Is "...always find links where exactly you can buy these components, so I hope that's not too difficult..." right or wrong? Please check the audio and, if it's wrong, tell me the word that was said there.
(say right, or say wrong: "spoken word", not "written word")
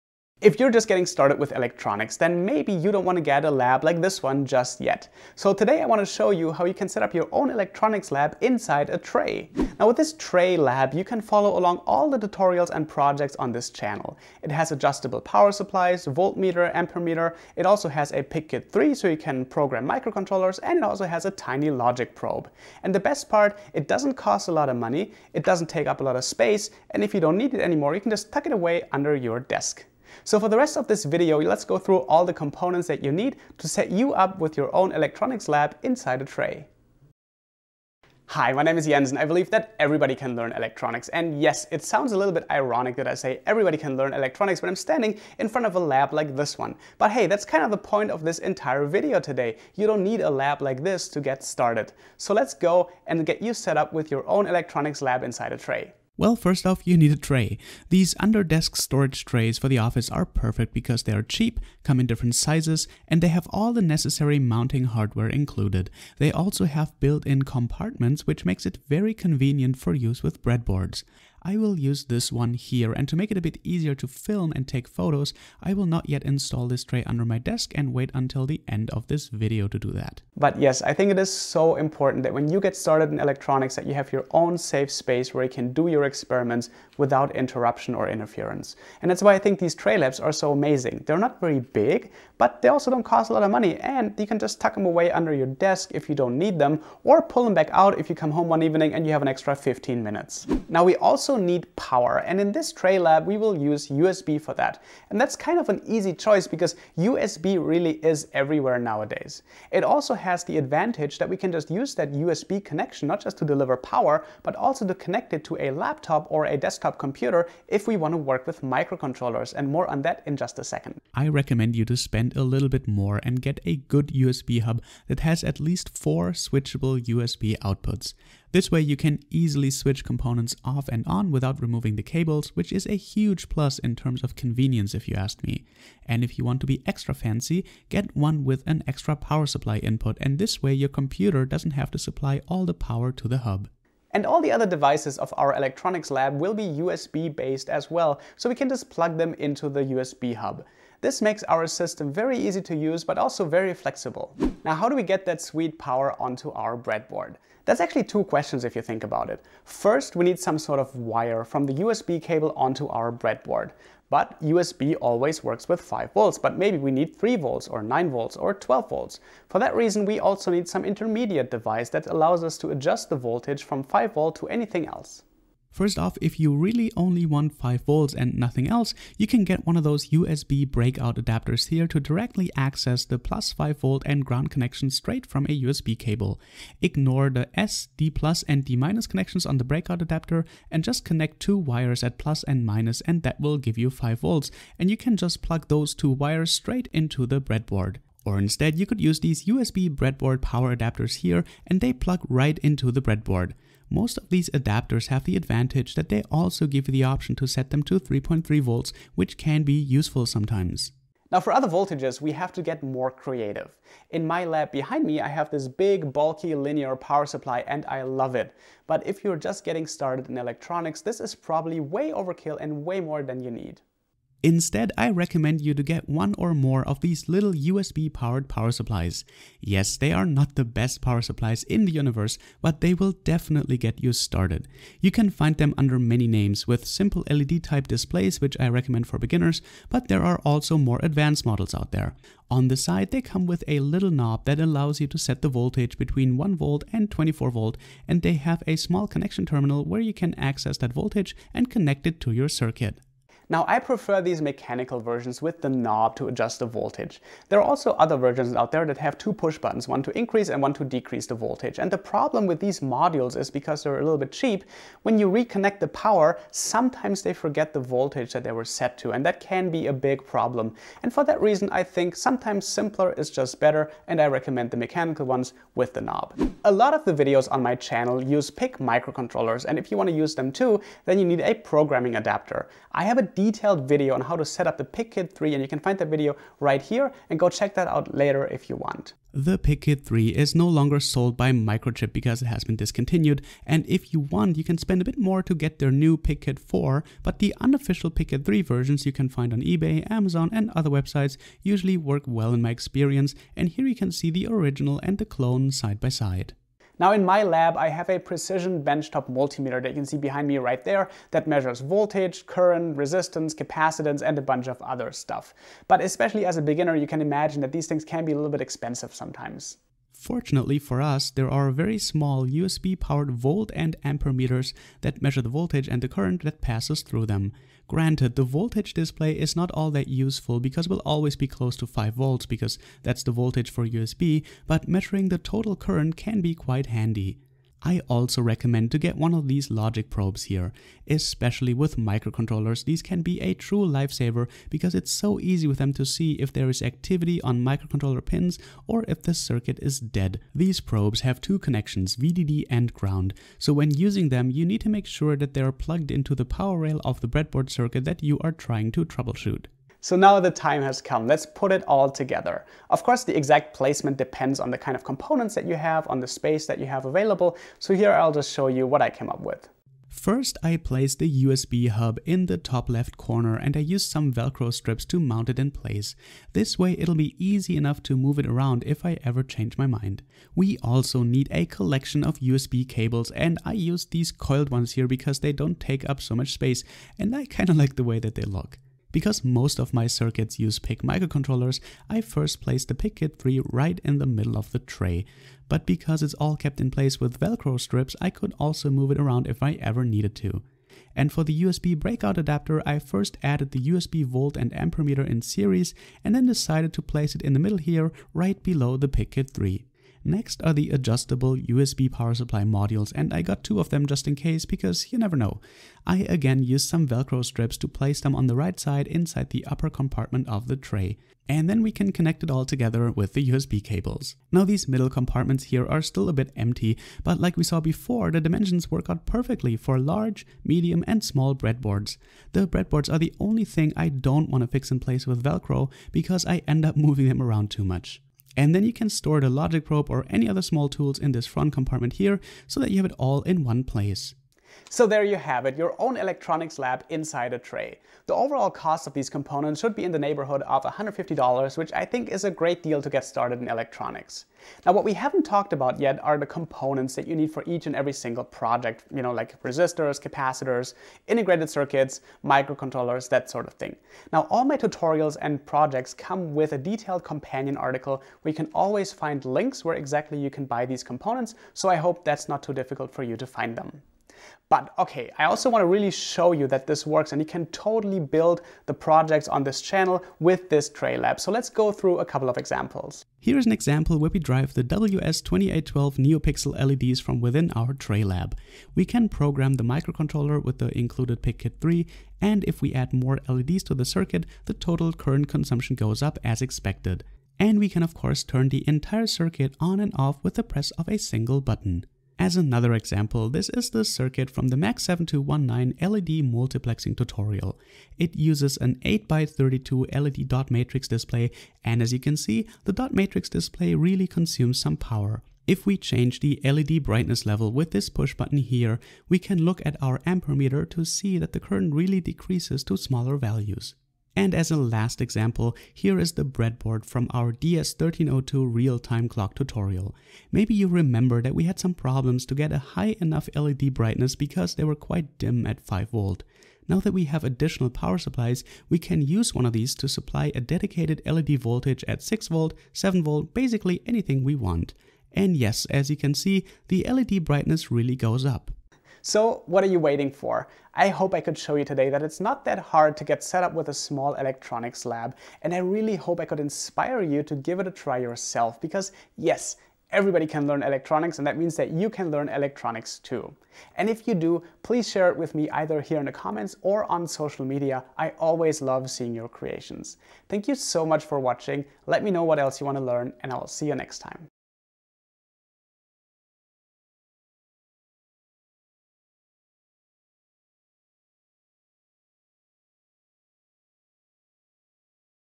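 right.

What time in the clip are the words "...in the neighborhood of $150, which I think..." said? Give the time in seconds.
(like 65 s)
450 s.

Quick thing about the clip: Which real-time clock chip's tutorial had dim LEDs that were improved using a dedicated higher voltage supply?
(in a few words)
DS1302.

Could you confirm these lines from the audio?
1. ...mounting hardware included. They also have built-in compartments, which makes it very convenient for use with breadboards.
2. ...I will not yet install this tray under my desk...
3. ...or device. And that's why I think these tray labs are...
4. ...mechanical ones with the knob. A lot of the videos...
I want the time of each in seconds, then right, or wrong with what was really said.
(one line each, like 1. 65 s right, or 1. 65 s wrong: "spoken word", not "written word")
1. 64 s right
2. 75 s right
3. 87 s wrong: "interference", not "device"
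4. 274 s right.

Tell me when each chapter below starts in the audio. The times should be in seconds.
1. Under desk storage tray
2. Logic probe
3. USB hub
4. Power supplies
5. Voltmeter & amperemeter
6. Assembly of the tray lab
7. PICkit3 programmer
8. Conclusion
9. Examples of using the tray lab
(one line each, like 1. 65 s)
1. 56 s
2. 337 s
3. 100 s
4. 154 s
5. 306 s
6. 359 s
7. 276 s
8. 549 s
9. 473 s.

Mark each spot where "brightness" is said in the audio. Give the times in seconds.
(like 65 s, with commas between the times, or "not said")
517 s, 533 s, 547 s.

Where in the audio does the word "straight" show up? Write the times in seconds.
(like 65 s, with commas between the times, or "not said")
184 s, 196 s.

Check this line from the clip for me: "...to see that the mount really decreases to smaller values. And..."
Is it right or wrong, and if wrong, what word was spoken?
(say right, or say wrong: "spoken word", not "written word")
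wrong: "current", not "mount".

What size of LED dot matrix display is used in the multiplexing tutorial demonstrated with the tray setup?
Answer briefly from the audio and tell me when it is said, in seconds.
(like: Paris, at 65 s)
8x32, at 509 s.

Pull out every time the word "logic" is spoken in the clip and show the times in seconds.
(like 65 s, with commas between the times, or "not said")
21 s, 339 s, 439 s.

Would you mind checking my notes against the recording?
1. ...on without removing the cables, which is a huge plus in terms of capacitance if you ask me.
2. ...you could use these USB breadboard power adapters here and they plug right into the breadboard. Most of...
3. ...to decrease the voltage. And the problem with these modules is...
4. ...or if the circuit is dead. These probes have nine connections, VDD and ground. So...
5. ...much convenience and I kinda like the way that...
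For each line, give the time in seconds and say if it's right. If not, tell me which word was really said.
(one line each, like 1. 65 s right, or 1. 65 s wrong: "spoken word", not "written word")
1. 131 s wrong: "convenience", not "capacitance"
2. 198 s right
3. 260 s right
4. 348 s wrong: "two", not "nine"
5. 386 s wrong: "space", not "convenience".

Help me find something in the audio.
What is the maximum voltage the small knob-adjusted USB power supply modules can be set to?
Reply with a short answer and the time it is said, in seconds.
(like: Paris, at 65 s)
24 volts, at 247 s.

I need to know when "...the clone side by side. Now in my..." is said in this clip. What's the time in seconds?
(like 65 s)
305 s.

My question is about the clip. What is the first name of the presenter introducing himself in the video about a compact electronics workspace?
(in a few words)
Jens.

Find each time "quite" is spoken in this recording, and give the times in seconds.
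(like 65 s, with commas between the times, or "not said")
336 s, 534 s.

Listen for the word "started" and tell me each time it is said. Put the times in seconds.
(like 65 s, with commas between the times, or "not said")
1 s, 51 s, 82 s, 219 s, 234 s, 453 s.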